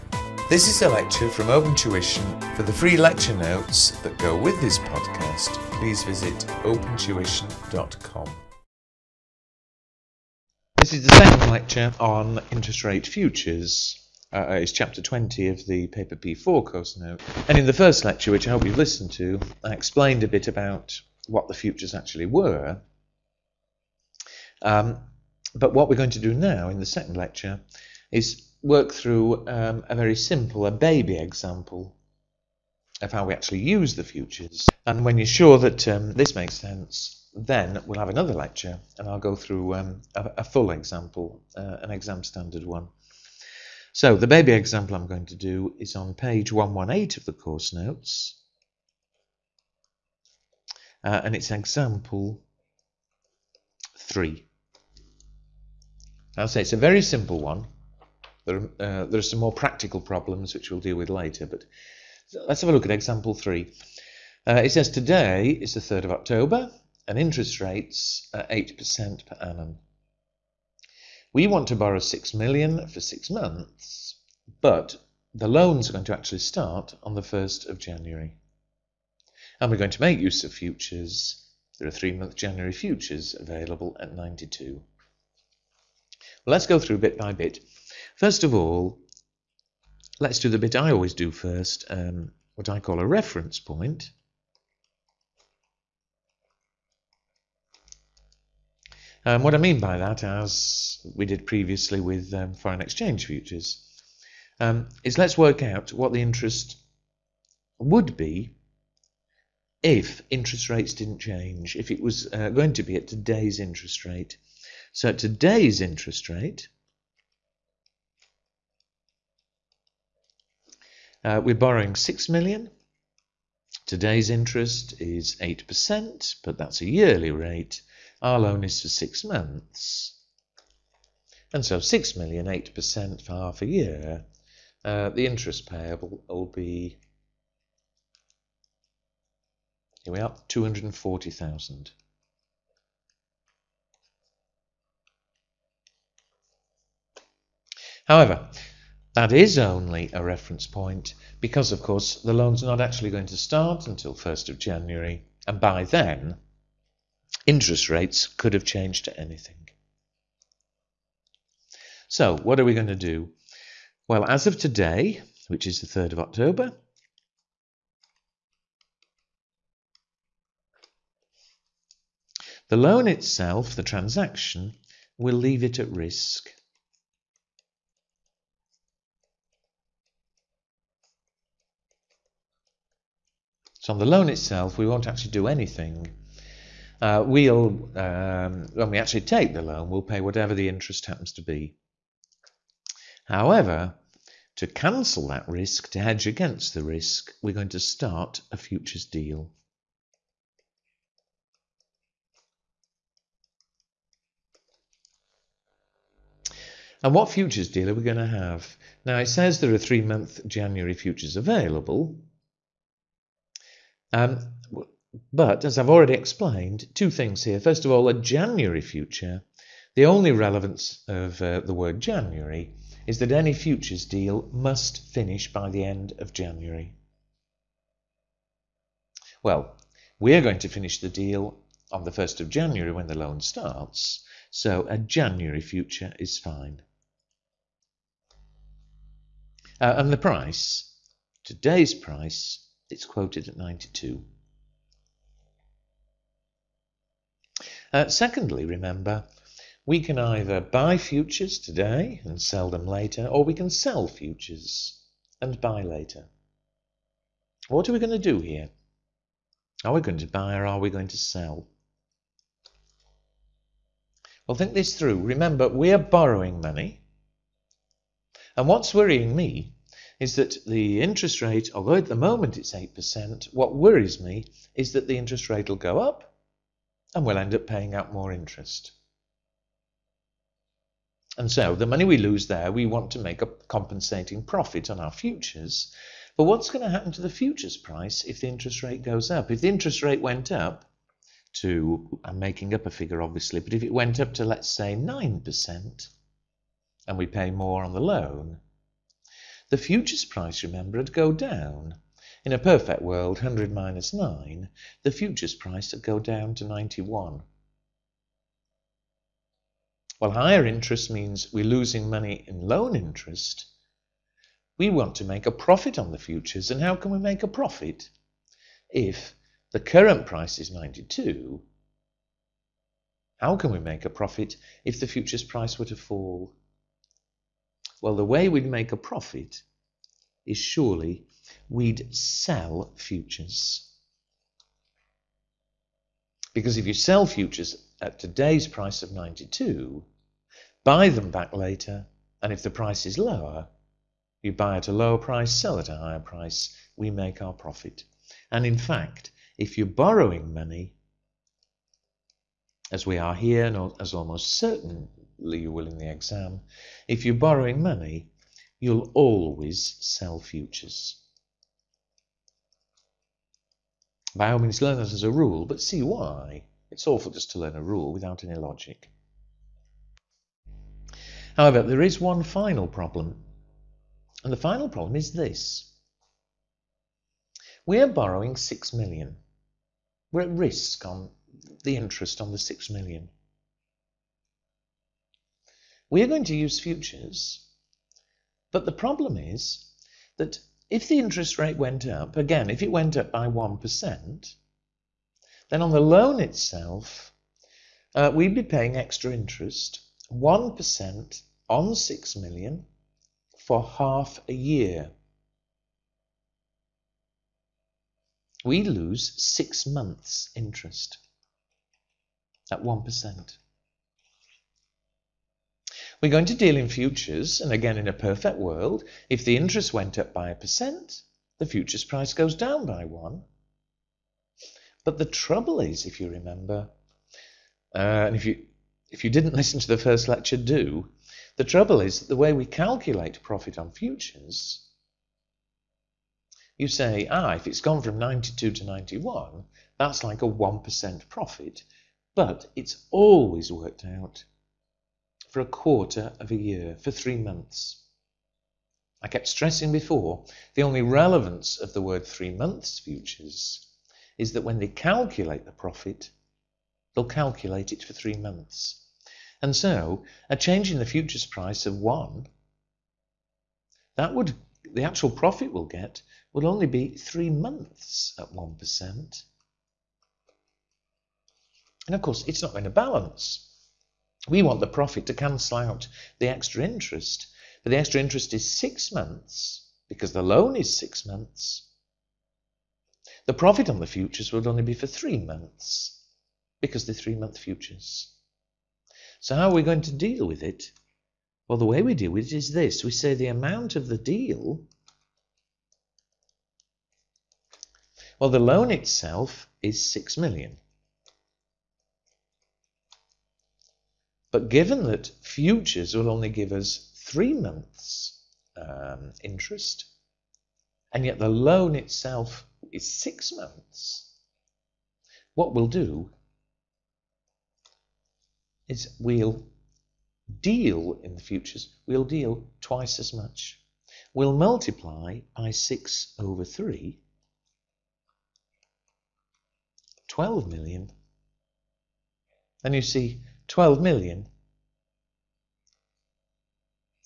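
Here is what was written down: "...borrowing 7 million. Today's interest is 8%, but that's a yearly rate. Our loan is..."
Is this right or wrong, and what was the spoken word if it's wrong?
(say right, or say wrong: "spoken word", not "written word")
wrong: "6", not "7".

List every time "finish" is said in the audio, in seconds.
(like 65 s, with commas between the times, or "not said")
225 s, 230 s.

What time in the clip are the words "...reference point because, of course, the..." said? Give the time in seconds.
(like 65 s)
150 s.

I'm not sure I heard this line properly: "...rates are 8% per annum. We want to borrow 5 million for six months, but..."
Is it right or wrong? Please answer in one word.
wrong.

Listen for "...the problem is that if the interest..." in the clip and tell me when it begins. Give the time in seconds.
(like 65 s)
388 s.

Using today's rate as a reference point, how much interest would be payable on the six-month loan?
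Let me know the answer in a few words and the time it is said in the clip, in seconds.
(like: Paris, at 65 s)
240,000, at 140 s.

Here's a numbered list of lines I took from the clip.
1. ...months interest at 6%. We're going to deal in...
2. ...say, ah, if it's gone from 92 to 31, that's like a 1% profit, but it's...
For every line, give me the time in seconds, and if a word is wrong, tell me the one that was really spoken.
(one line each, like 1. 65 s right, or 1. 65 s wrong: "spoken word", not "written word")
1. 409 s wrong: "1", not "6"
2. 436 s wrong: "91", not "31".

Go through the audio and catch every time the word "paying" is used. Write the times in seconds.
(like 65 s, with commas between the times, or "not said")
277 s, 398 s.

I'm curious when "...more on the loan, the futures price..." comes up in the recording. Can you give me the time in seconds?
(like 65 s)
297 s.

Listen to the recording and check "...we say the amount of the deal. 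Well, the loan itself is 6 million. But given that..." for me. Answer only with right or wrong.
right.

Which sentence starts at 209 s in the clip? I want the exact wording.
Now it says there are three month January futures available.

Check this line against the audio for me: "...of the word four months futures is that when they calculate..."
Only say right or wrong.
wrong.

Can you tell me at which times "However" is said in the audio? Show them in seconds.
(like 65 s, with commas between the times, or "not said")
148 s, 193 s, 371 s.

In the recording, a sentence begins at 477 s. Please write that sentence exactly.
But the extra interest is six months because the loan is six months.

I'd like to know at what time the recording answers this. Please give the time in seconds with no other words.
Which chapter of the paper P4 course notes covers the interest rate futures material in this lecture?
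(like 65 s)
14 s.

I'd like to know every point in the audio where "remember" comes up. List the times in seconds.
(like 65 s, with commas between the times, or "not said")
248 s, 265 s, 300 s, 426 s.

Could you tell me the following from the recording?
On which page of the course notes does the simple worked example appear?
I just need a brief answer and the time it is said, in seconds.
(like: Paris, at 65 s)
118, at 46 s.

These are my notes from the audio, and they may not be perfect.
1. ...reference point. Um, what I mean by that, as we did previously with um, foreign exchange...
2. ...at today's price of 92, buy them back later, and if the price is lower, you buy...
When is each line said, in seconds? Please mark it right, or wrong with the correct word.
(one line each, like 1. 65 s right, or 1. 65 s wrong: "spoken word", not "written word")
1. 93 s right
2. 338 s right.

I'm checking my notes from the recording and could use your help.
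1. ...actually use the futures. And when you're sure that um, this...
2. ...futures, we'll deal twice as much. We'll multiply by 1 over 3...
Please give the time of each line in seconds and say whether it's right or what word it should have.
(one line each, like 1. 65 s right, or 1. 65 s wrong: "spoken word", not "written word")
1. 33 s right
2. 521 s wrong: "6", not "1".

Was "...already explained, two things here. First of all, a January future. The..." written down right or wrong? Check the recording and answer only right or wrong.
right.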